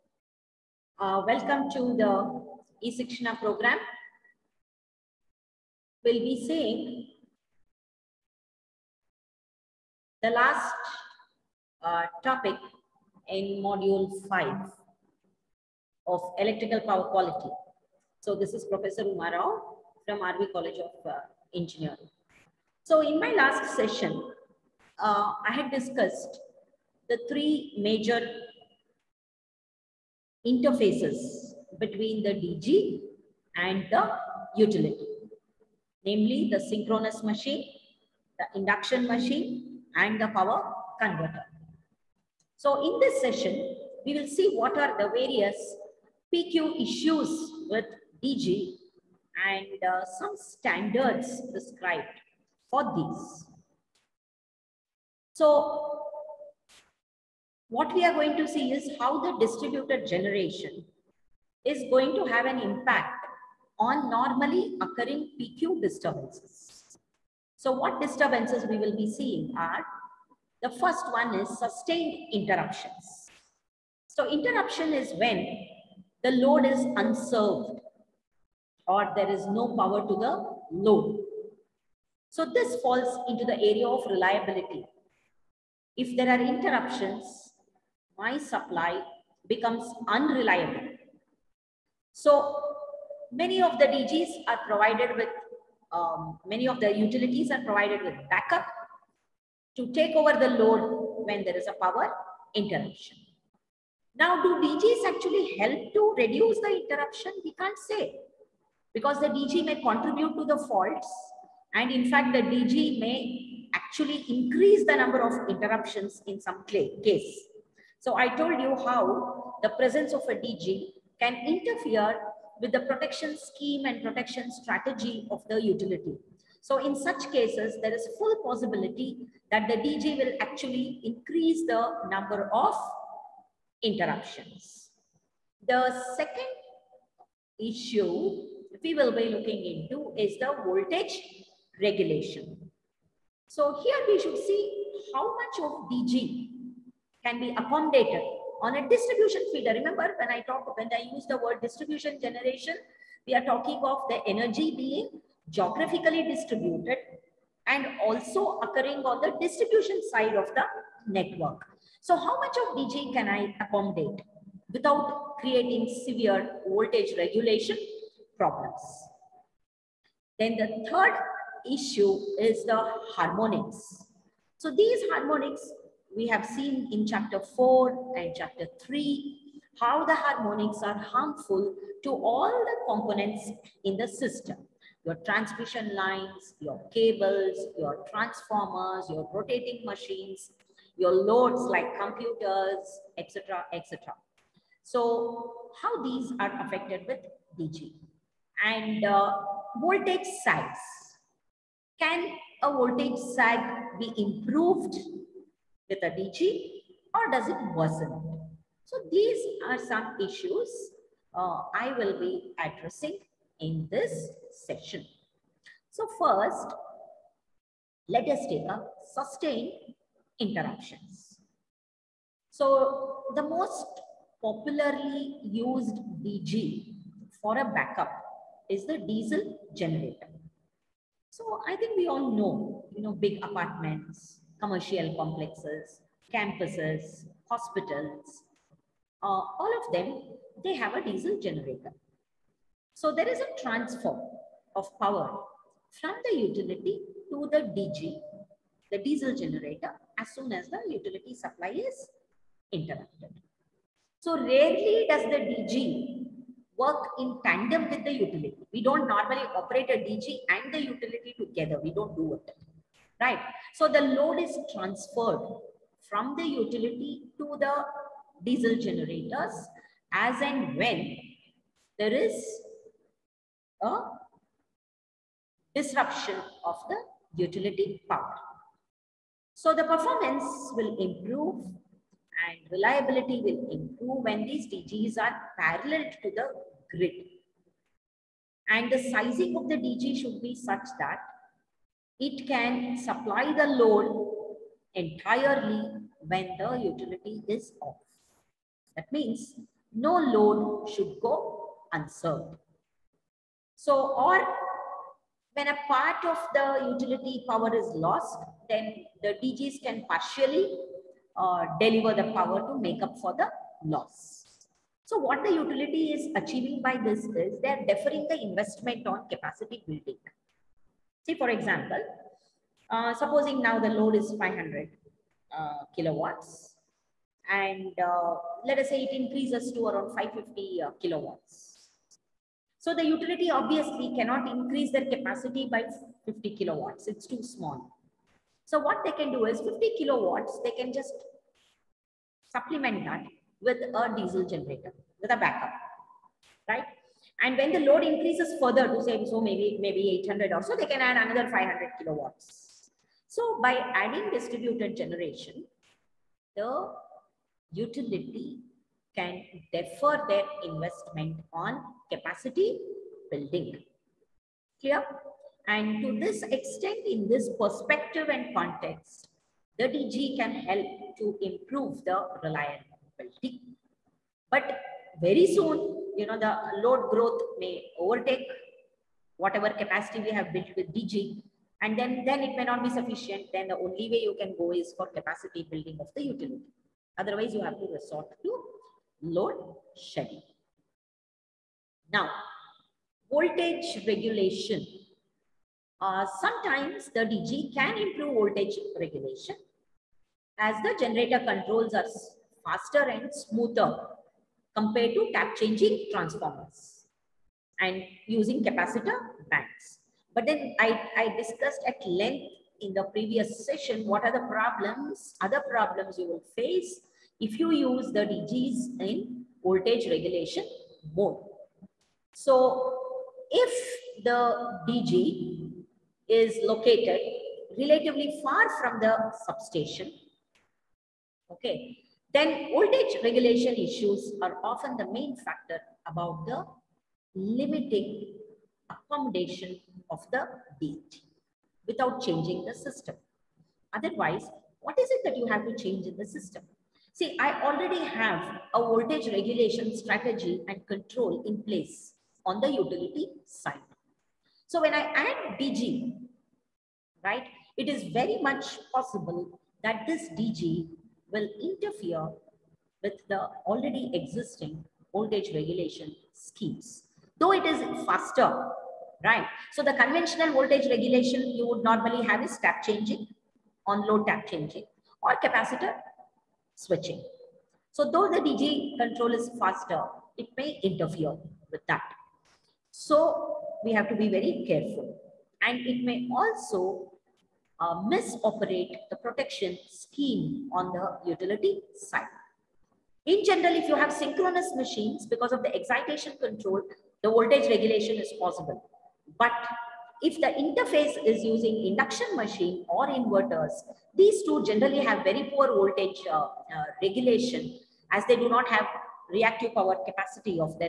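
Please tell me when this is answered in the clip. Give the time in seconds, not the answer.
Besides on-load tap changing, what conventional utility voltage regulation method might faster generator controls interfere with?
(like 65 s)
475 s.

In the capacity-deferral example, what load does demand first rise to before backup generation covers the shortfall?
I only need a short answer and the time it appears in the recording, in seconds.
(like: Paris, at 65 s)
550 kilowatts, at 330 s.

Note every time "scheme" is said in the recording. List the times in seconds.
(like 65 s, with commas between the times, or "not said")
123 s, 466 s, 489 s.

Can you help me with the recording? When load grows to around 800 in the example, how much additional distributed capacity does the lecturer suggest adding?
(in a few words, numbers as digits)
500 kilowatts.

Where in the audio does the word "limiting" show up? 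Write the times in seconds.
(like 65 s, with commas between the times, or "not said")
437 s.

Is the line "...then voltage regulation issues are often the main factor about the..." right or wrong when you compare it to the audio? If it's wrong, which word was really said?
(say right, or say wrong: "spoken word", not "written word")
right.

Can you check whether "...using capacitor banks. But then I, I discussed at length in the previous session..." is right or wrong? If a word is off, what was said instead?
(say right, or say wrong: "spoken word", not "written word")
right.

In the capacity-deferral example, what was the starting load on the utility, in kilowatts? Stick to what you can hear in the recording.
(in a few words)
500 kilowatts.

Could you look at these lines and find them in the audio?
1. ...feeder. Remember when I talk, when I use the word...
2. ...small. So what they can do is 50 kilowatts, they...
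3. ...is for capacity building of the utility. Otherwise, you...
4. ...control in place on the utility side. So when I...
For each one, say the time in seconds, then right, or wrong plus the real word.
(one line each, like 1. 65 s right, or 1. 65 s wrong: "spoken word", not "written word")
1. 149 s right
2. 337 s right
3. 384 s right
4. 450 s right.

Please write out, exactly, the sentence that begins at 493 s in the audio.
In general, if you have synchronous machines, because of the excitation control, the voltage regulation is possible.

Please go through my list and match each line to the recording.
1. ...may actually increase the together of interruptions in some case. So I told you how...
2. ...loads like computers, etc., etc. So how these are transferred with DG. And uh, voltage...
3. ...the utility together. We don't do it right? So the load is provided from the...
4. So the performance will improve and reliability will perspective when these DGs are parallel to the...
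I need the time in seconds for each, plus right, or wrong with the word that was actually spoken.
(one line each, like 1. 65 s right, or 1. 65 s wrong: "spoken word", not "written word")
1. 113 s wrong: "number", not "together"
2. 191 s wrong: "affected", not "transferred"
3. 260 s wrong: "transferred", not "provided"
4. 279 s wrong: "improve", not "perspective".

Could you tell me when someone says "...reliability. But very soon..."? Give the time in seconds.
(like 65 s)
372 s.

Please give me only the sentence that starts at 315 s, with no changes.
So what the utility is achieving by this is they are deferring the investment on capacity building.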